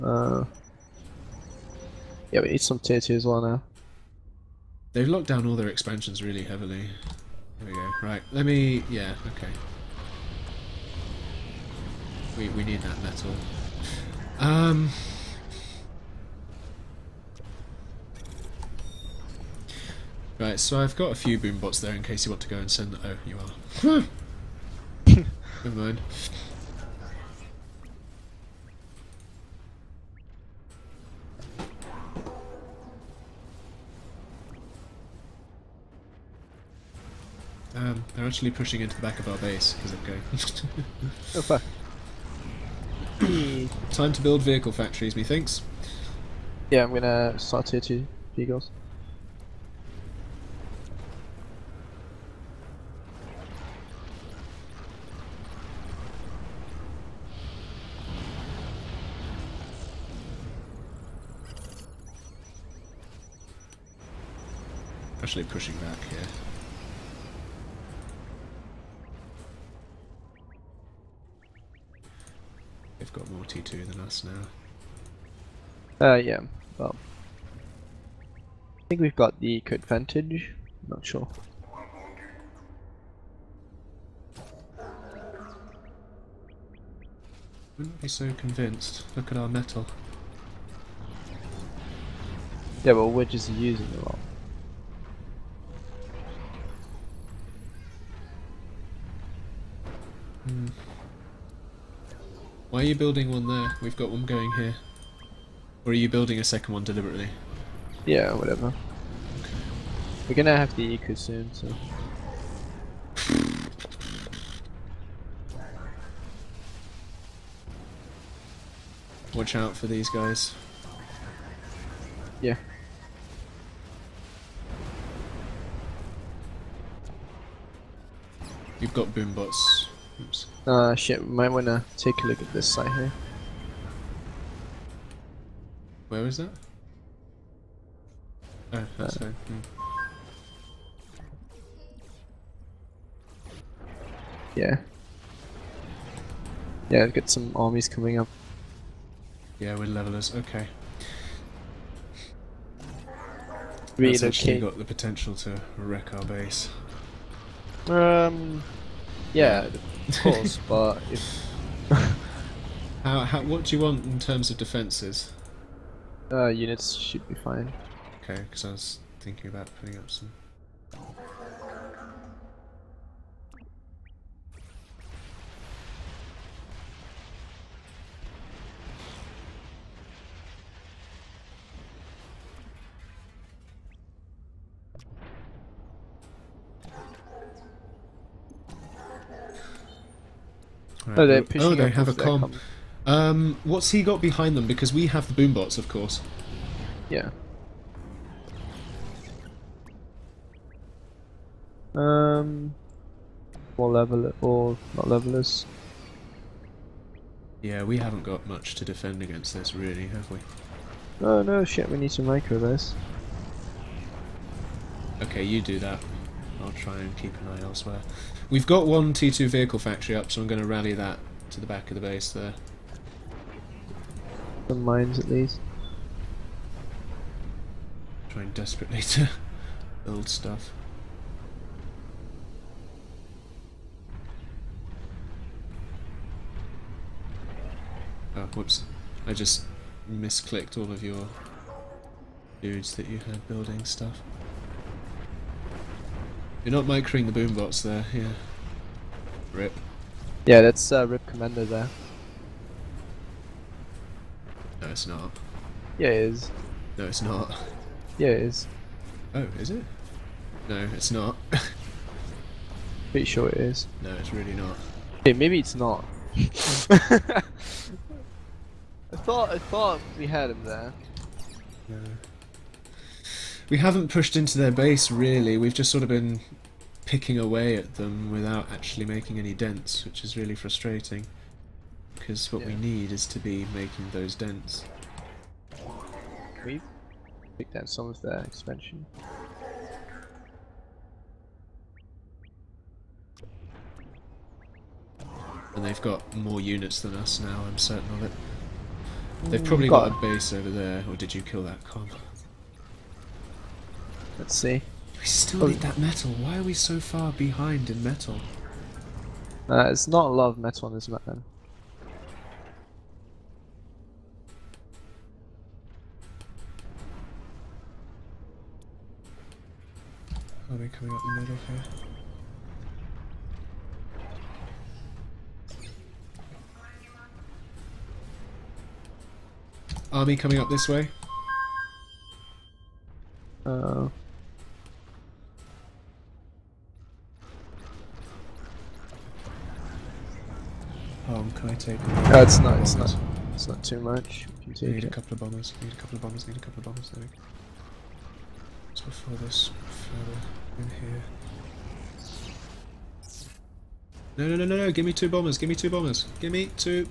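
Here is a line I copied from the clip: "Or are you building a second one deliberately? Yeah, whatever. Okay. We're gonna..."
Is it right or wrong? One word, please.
right.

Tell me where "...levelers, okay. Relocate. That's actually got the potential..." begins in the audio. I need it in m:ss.
2:29.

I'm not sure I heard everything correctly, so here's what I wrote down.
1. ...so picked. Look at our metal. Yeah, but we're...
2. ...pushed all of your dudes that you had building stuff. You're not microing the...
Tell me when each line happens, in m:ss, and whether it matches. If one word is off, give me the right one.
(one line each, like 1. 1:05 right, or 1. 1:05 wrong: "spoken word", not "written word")
1. 1:28 wrong: "convinced", not "picked"
2. 4:00 wrong: "misclicked", not "pushed".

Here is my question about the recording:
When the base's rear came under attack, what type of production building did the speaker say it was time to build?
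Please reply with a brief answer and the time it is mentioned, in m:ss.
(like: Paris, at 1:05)
vehicle factories, at 0:44.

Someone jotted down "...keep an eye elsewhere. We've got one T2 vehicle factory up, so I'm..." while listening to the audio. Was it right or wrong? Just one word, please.
right.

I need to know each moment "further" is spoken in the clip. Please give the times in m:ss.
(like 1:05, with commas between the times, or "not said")
5:49.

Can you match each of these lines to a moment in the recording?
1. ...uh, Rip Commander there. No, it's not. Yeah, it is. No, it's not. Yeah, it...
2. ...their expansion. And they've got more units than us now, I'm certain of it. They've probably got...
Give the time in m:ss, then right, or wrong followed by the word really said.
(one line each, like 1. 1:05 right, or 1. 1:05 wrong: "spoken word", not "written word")
1. 4:10 right
2. 4:48 right.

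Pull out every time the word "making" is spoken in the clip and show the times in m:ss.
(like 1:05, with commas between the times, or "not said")
4:39, 4:43.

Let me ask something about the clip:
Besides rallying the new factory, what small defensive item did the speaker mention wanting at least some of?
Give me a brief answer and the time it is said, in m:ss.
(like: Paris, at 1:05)
mines, at 3:44.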